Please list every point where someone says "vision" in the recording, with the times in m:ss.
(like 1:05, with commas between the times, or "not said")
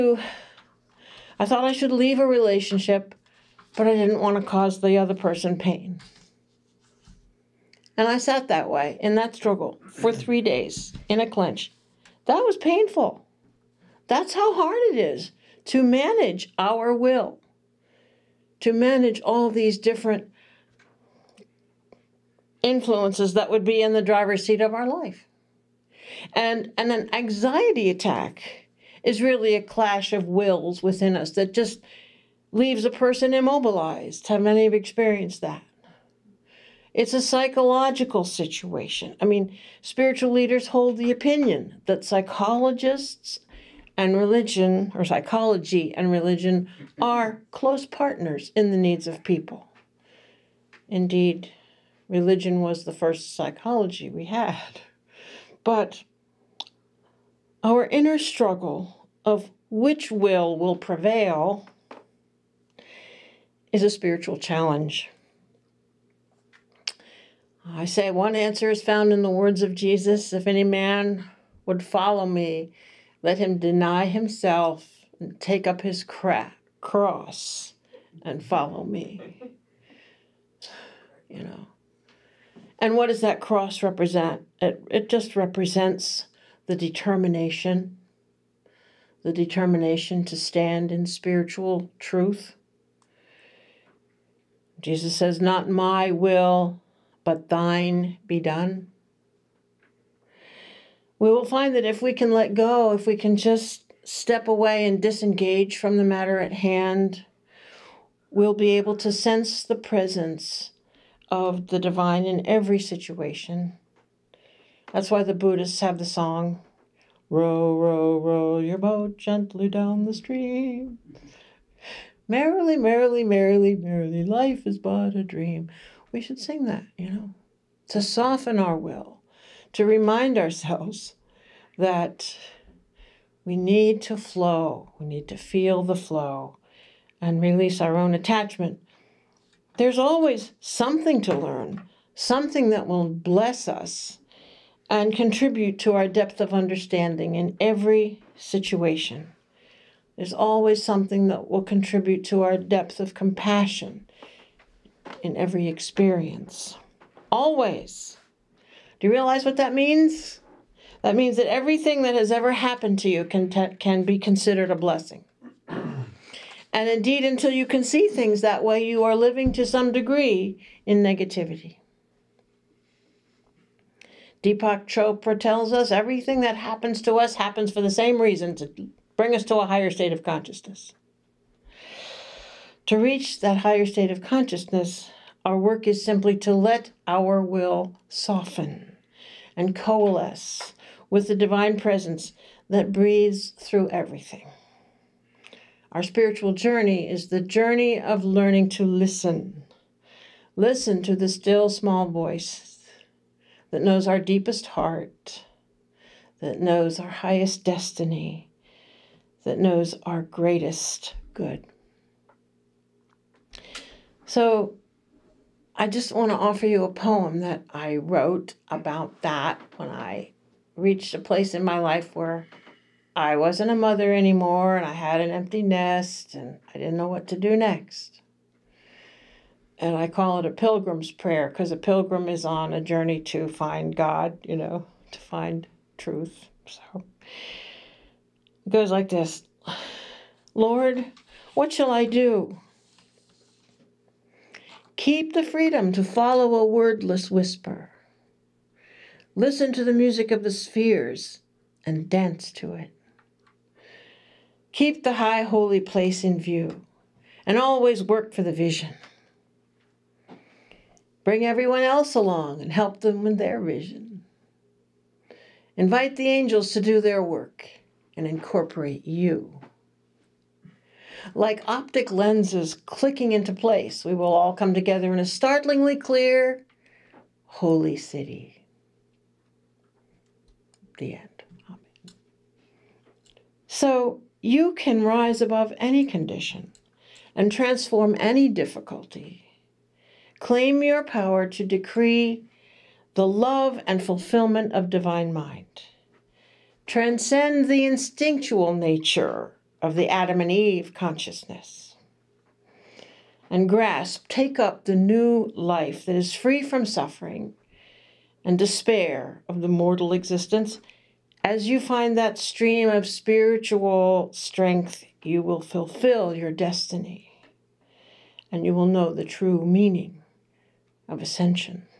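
4:18, 4:23.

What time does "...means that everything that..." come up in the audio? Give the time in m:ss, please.
2:41.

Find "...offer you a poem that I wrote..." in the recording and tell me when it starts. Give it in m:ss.
3:36.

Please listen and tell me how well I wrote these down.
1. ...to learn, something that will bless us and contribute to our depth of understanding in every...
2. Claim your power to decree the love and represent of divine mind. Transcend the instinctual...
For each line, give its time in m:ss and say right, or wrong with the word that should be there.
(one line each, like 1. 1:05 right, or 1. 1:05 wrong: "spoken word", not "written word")
1. 2:21 right
2. 4:50 wrong: "fulfillment", not "represent".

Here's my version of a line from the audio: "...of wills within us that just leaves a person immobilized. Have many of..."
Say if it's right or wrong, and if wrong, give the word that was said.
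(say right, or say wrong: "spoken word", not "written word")
right.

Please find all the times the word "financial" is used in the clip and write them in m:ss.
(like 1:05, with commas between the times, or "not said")
not said.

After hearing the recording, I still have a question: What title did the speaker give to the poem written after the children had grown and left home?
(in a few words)
A Pilgrim's Prayer.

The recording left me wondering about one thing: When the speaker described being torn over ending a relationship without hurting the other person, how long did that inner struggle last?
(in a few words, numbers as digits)
3 days.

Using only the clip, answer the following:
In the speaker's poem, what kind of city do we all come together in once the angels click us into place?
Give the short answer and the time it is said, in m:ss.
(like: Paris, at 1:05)
holy city, at 4:37.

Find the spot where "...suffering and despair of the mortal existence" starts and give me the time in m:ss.
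5:06.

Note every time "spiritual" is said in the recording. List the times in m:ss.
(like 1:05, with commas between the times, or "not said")
0:39, 1:03, 1:31, 3:16, 5:13.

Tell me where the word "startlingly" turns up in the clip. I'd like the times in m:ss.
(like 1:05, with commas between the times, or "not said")
4:35.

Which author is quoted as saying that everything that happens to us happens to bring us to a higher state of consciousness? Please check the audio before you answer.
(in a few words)
Deepak Chopra.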